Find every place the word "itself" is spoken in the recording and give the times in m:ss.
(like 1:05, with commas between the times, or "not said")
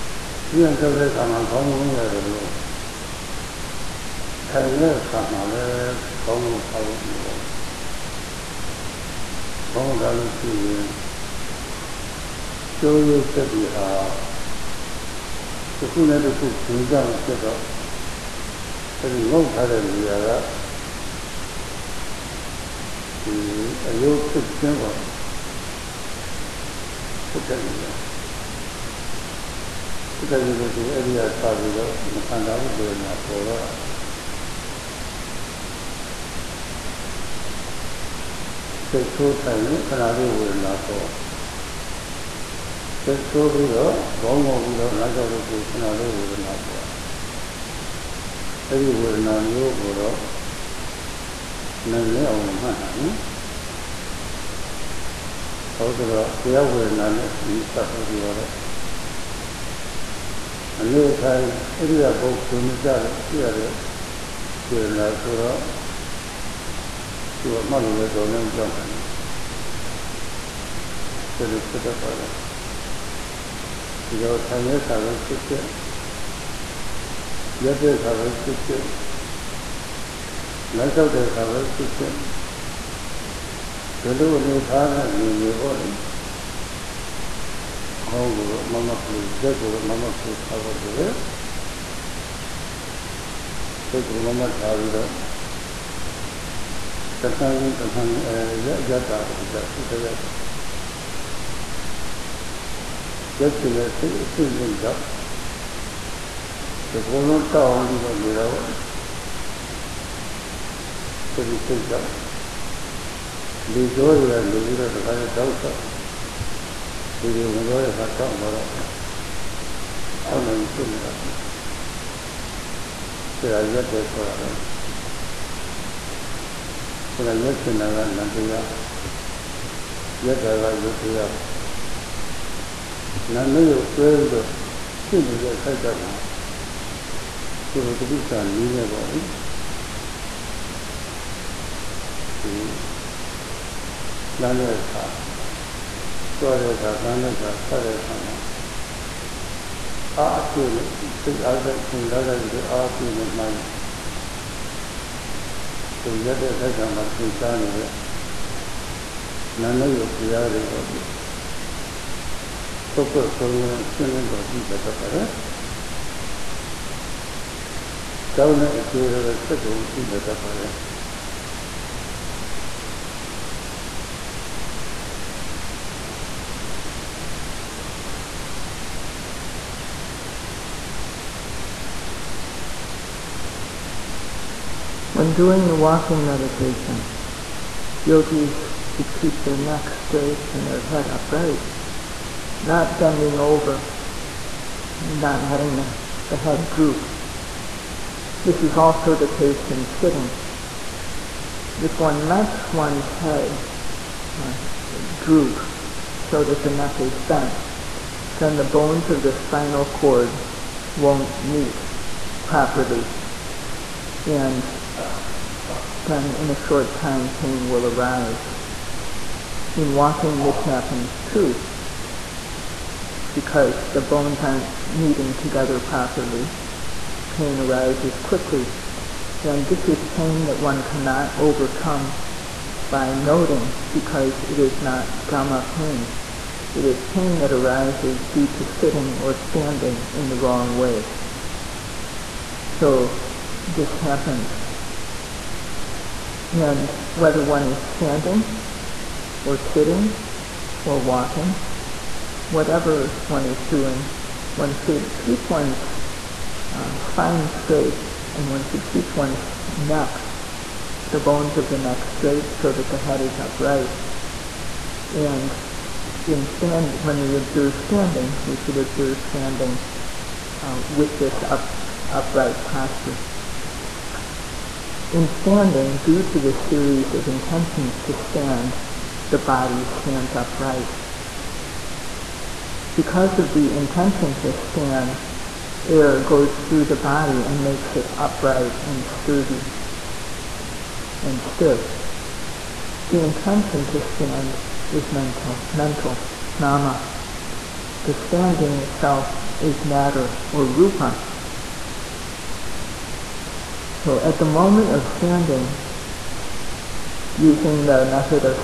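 4:58.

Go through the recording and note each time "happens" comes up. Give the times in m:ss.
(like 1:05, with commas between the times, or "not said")
3:40, 4:04.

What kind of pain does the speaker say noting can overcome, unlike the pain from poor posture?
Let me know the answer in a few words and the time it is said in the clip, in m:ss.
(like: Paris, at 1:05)
Dhamma pain, at 3:55.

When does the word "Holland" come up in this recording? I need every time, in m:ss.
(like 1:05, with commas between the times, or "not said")
not said.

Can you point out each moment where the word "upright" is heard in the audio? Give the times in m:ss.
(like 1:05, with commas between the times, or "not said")
3:11, 4:23, 4:32, 4:40, 4:48.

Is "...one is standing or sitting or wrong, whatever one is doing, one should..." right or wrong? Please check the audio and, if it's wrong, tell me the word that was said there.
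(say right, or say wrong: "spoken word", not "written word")
wrong: "walking", not "wrong".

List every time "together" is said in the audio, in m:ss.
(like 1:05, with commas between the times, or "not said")
3:45.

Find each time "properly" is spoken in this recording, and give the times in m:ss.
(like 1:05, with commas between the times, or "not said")
3:32, 3:45.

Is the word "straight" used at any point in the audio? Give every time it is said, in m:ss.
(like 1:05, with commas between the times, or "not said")
3:10, 4:17, 4:22.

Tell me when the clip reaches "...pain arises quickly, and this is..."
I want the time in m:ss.
3:47.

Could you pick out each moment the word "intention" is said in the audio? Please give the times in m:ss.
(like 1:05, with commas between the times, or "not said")
4:37, 4:43, 4:53.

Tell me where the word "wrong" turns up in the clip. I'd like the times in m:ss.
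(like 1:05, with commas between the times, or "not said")
4:00.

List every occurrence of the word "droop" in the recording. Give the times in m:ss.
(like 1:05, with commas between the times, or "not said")
3:16, 3:25.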